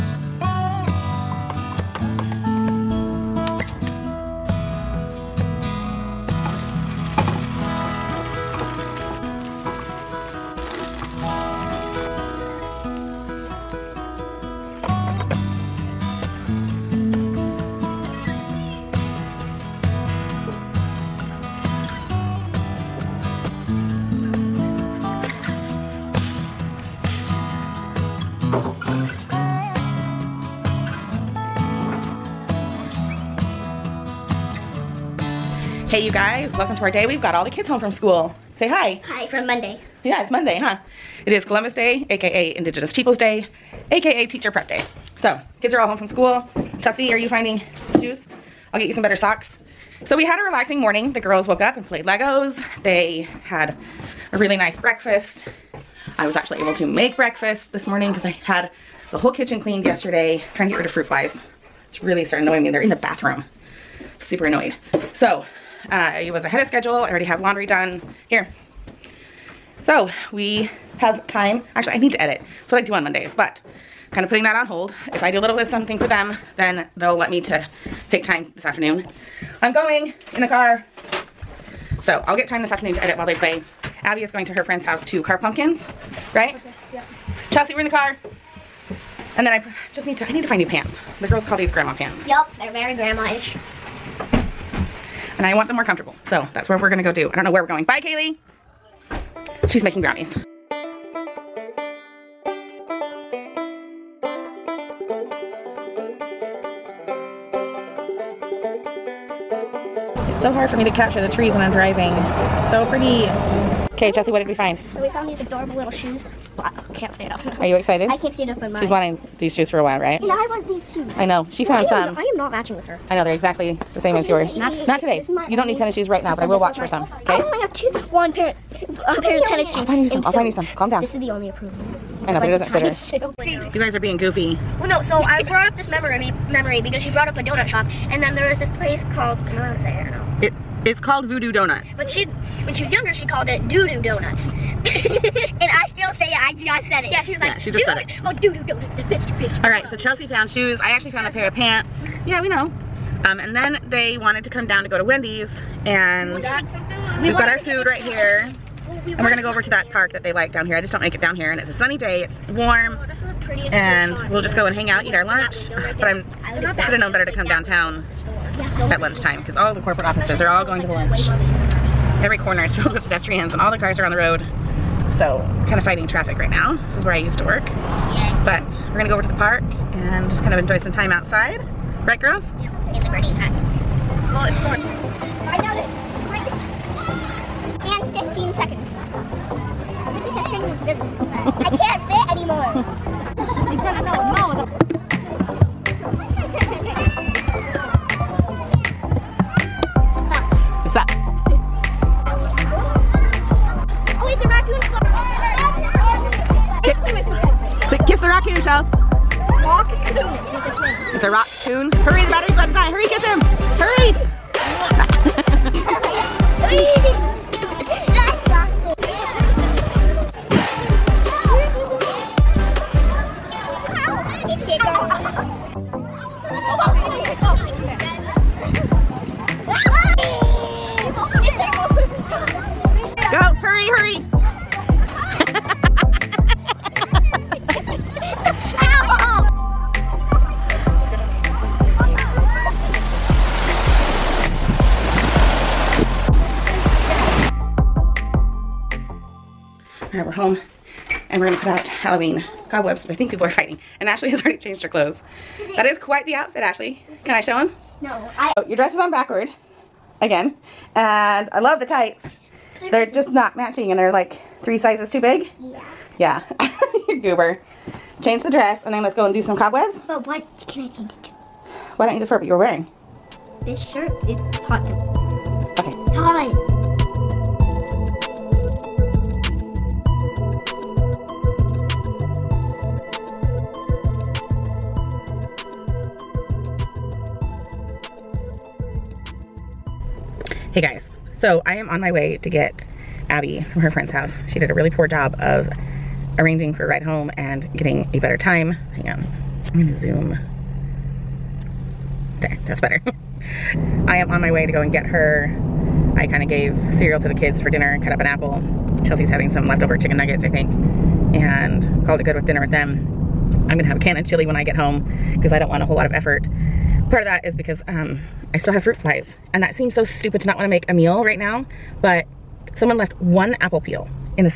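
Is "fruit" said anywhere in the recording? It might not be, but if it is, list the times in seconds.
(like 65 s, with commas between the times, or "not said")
60 s, 318 s.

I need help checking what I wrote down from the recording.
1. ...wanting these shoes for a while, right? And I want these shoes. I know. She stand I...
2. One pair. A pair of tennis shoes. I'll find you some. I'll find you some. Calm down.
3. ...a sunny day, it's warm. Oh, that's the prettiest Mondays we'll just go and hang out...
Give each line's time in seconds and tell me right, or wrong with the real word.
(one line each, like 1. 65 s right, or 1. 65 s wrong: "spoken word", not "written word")
1. 118 s wrong: "found", not "stand"
2. 128 s right
3. 161 s wrong: "And", not "Mondays".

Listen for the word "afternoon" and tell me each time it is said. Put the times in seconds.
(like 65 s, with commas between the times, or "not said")
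78 s, 82 s.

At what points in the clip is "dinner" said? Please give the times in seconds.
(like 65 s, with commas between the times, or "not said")
307 s, 312 s.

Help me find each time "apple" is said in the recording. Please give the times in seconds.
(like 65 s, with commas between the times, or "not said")
308 s, 323 s.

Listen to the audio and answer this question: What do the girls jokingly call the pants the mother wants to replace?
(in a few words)
Grandma pants.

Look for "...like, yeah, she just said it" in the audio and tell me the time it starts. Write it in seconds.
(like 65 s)
147 s.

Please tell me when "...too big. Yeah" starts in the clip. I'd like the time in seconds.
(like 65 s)
265 s.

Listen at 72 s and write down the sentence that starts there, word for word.
That's what I do on Mondays, but kind of putting that on hold.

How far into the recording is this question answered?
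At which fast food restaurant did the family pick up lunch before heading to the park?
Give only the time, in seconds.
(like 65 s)
155 s.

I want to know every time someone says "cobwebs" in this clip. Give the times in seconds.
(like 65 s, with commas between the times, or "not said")
252 s, 269 s.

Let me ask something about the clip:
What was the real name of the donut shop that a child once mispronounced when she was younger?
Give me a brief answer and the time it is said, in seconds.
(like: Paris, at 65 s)
Voodoo Donut, at 141 s.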